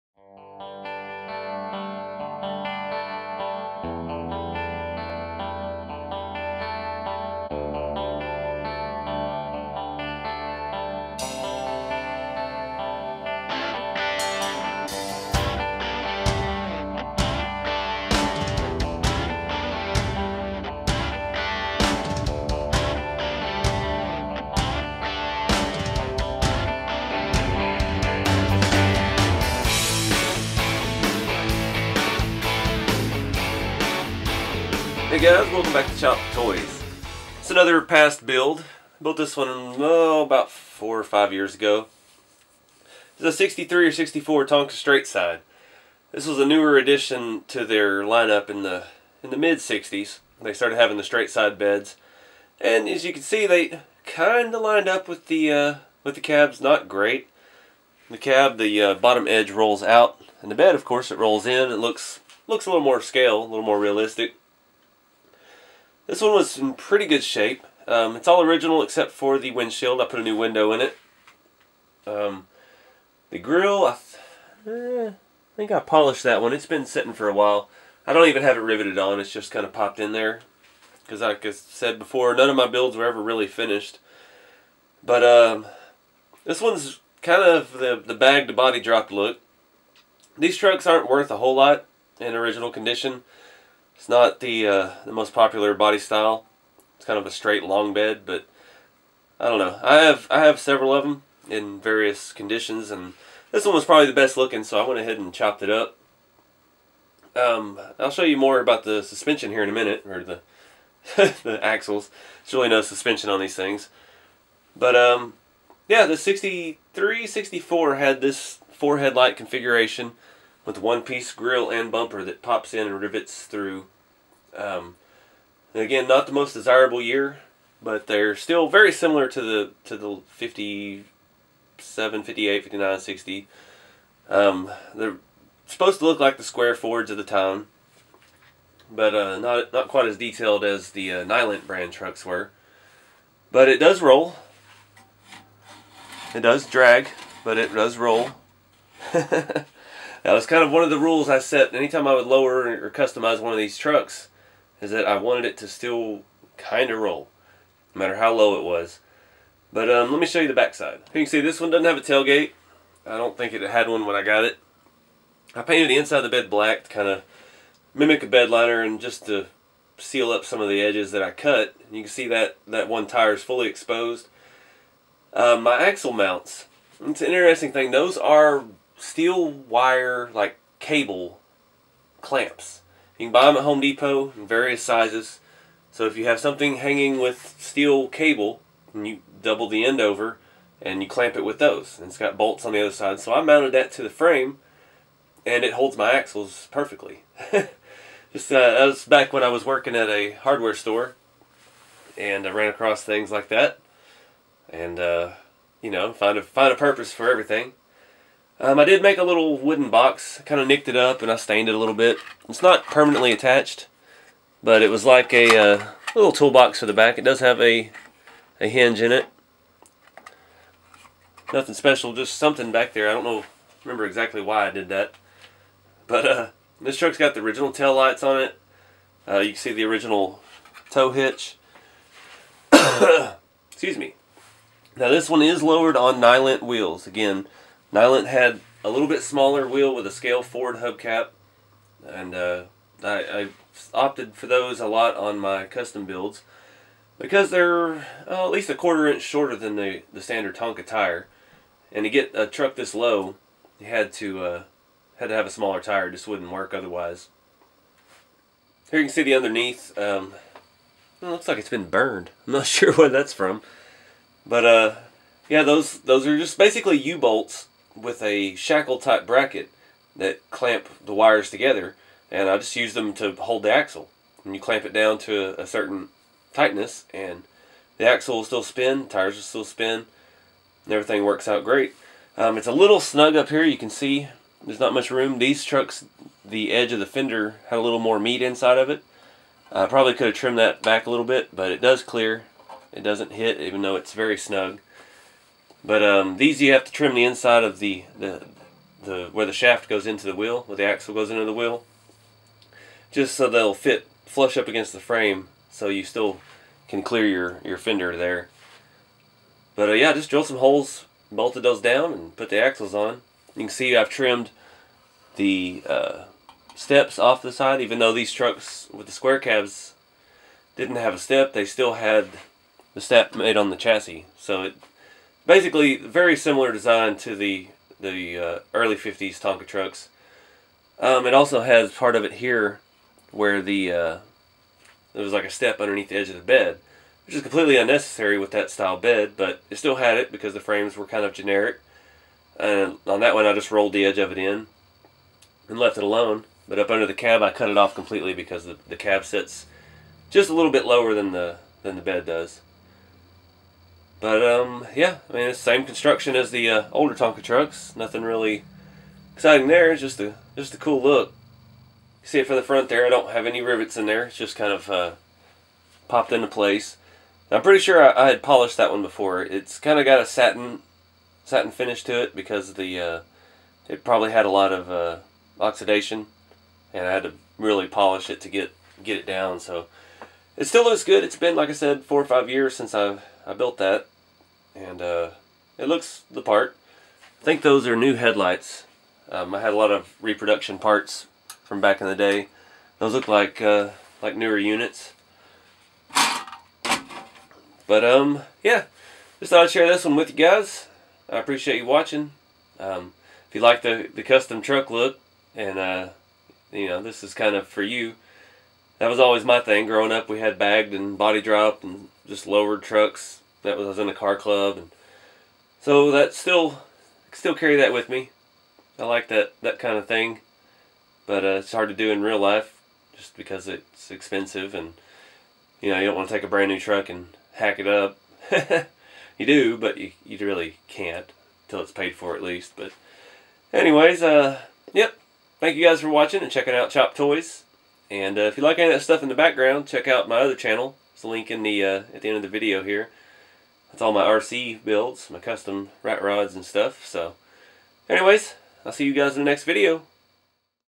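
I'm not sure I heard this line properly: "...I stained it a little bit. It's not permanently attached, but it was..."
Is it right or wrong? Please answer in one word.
right.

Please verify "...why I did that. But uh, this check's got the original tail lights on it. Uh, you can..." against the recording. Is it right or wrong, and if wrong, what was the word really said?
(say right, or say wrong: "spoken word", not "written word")
wrong: "truck", not "check".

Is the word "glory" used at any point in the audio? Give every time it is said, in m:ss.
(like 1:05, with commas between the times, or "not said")
not said.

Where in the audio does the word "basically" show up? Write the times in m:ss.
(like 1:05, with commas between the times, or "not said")
4:26, 5:25.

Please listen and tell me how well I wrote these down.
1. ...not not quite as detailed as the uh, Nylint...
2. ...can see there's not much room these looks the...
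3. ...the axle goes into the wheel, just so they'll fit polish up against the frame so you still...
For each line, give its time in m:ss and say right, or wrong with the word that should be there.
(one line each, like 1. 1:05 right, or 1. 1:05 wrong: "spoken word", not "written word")
1. 2:19 right
2. 4:43 wrong: "trucks", not "looks"
3. 5:00 wrong: "flush", not "polish".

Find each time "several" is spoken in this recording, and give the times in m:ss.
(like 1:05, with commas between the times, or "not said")
1:40.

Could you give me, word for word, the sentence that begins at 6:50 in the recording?
We had bagged and body dropped and just lowered trucks.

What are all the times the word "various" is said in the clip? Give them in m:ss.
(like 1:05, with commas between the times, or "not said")
1:41, 3:04.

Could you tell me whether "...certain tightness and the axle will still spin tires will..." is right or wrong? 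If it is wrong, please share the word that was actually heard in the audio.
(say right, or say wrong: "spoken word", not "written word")
right.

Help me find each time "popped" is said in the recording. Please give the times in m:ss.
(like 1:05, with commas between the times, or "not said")
1:19, 6:06.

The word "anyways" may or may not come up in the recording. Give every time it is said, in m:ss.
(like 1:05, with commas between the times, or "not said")
7:13, 7:28.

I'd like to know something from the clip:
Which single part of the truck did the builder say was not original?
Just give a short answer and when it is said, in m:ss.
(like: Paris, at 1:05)
windshield, at 1:09.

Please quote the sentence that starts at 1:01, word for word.
It looks looks a little more scale, a little more realistic.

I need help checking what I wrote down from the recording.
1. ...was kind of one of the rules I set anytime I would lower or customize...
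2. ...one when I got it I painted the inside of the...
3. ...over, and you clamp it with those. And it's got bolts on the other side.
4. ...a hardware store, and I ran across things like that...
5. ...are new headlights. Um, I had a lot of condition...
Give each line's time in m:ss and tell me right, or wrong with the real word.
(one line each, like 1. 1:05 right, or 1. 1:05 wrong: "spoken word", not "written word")
1. 2:30 right
2. 2:43 right
3. 3:09 right
4. 3:20 right
5. 6:27 wrong: "reproduction", not "condition".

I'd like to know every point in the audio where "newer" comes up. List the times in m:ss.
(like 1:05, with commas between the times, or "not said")
0:46, 6:34.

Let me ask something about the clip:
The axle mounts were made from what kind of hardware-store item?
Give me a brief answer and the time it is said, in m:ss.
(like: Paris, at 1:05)
cable clamps, at 3:00.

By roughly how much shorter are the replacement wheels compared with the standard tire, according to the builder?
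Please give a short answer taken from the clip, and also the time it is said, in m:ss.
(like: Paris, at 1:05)
a quarter inch, at 4:08.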